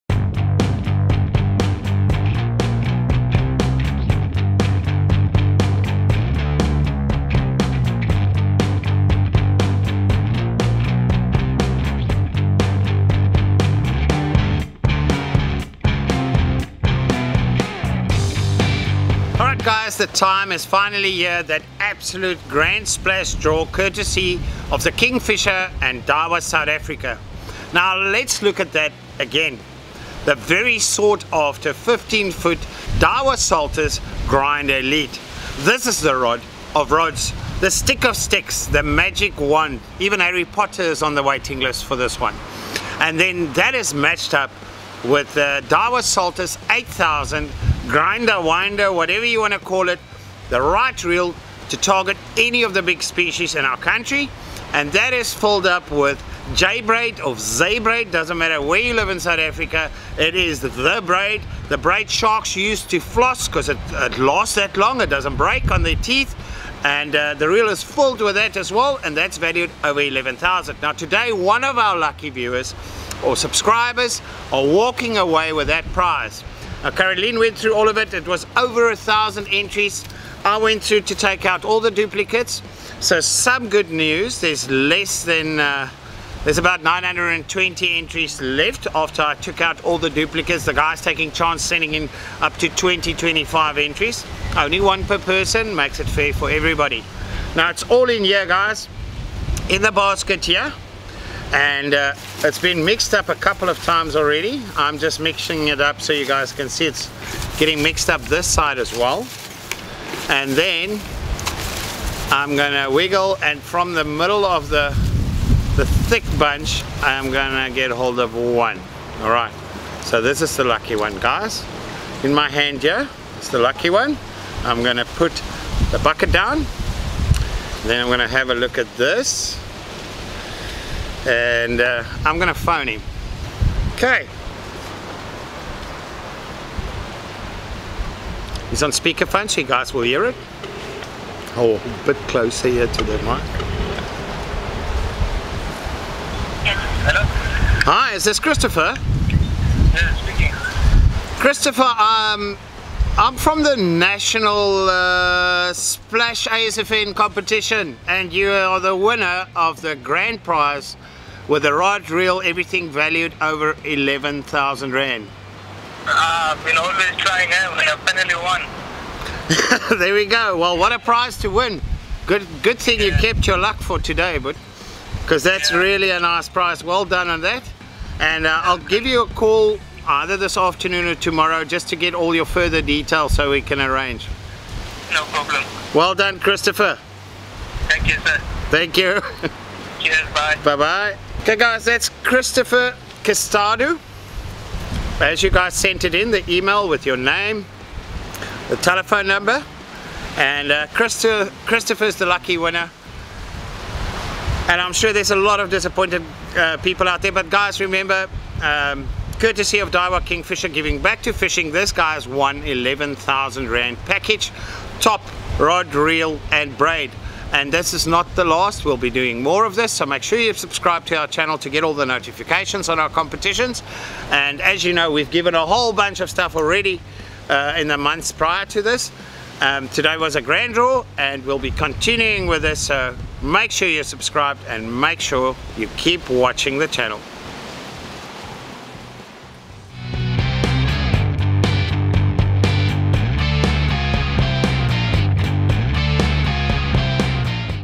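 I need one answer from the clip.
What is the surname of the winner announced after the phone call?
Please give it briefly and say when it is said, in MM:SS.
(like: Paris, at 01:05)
Castadu, at 03:13.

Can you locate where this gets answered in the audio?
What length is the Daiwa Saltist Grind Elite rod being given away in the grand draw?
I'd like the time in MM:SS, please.
00:31.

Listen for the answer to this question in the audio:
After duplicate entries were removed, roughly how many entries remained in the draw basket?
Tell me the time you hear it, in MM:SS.
01:26.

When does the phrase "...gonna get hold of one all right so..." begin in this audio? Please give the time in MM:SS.
01:57.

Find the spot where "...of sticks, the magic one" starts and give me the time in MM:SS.
00:38.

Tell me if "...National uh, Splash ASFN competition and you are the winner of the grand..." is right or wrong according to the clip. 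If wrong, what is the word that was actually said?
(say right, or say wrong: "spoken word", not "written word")
right.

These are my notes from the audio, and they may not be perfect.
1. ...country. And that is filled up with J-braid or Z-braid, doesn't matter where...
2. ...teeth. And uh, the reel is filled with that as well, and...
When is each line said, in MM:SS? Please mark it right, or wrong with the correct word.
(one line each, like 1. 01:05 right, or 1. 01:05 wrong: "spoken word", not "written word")
1. 00:53 right
2. 01:05 right.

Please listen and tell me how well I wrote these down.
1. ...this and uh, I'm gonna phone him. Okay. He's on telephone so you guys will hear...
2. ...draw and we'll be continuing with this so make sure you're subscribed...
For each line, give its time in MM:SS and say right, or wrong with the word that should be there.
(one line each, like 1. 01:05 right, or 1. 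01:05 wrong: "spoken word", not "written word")
1. 02:08 wrong: "speakerphone", not "telephone"
2. 03:50 right.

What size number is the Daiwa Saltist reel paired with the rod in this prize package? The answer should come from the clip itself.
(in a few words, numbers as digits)
8000.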